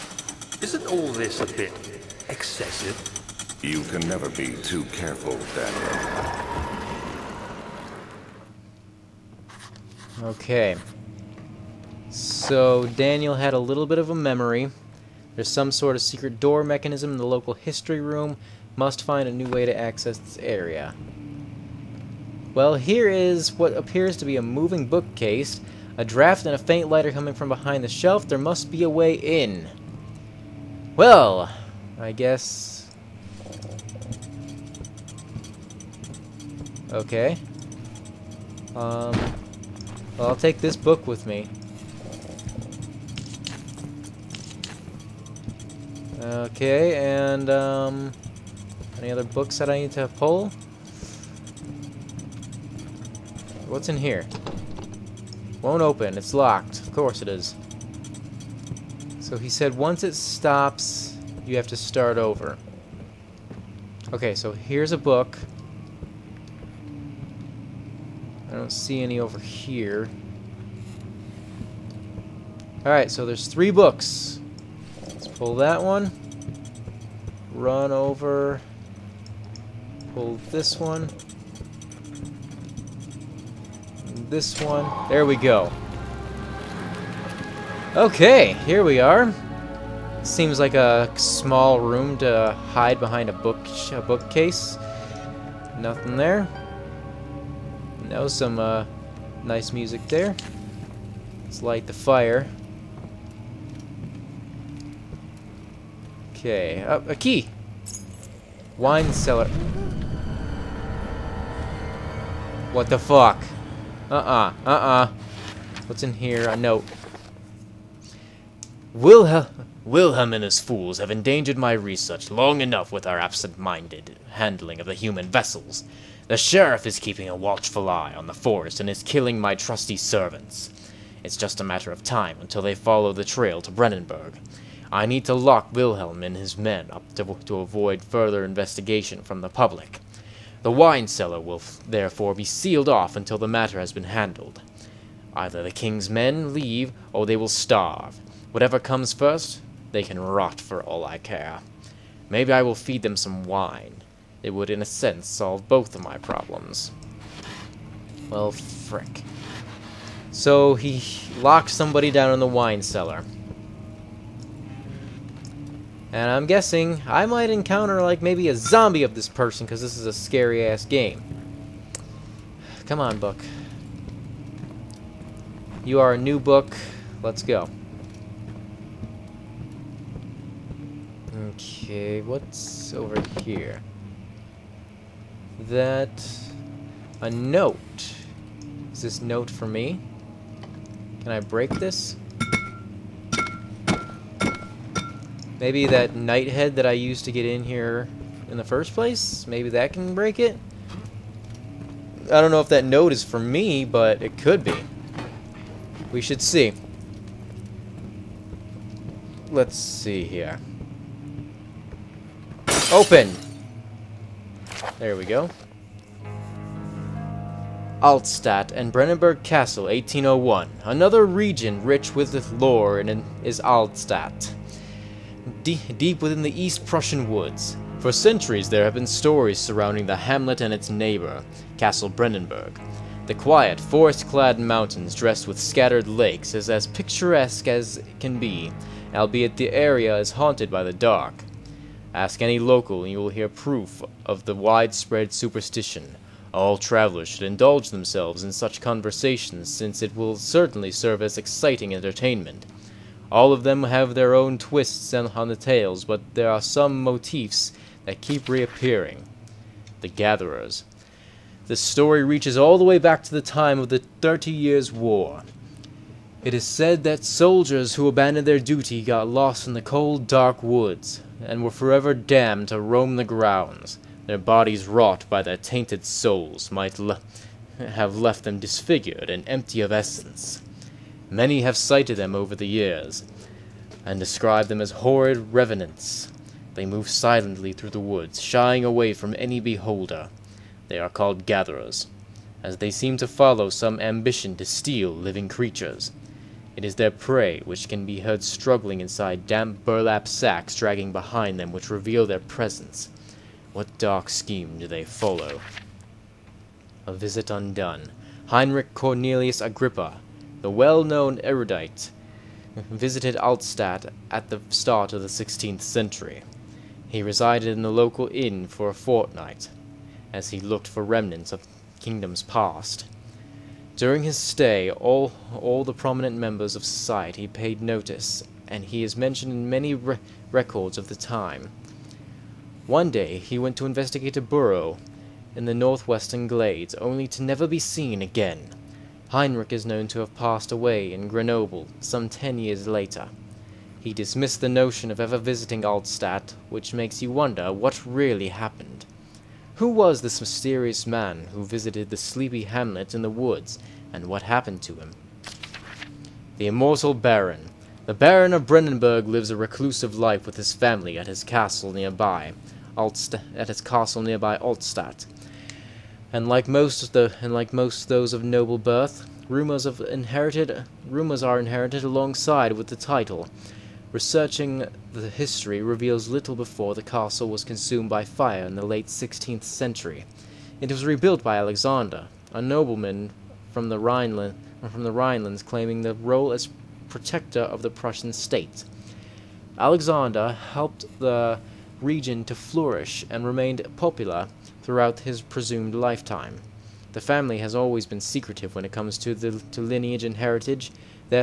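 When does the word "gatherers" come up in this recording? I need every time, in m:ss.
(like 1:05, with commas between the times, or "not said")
4:20, 4:51.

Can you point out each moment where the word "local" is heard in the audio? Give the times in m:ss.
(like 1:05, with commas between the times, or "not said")
0:17, 4:02, 5:17.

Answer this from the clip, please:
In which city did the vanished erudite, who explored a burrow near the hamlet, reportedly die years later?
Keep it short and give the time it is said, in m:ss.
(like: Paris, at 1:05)
Grenoble, at 5:41.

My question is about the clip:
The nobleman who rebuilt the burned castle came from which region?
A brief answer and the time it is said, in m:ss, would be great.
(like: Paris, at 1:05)
Rhineland, at 6:23.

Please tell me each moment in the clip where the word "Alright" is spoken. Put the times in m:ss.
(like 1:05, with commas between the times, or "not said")
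1:12.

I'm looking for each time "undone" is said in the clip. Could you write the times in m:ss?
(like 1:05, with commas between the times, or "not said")
5:07.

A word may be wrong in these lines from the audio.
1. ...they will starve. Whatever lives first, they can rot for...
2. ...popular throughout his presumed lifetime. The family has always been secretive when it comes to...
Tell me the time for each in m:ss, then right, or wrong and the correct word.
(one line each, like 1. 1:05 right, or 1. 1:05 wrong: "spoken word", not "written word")
1. 2:27 wrong: "comes", not "lives"
2. 6:33 right.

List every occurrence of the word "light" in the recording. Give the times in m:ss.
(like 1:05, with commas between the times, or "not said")
0:26, 1:41.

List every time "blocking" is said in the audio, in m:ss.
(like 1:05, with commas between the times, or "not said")
not said.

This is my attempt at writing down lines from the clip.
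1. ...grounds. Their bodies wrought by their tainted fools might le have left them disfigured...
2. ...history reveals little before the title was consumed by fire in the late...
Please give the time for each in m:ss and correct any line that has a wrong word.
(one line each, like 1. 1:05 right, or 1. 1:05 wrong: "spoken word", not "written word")
1. 4:33 wrong: "souls", not "fools"
2. 6:15 wrong: "castle", not "title".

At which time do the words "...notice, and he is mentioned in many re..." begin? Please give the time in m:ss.
5:27.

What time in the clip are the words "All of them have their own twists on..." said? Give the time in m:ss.
4:13.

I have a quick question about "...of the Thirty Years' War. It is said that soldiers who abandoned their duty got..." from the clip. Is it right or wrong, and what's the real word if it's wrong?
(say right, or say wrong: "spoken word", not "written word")
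right.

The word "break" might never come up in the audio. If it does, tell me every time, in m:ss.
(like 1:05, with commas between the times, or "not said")
3:11, 3:20.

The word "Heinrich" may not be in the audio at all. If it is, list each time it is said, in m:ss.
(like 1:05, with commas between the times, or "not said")
5:08, 5:39.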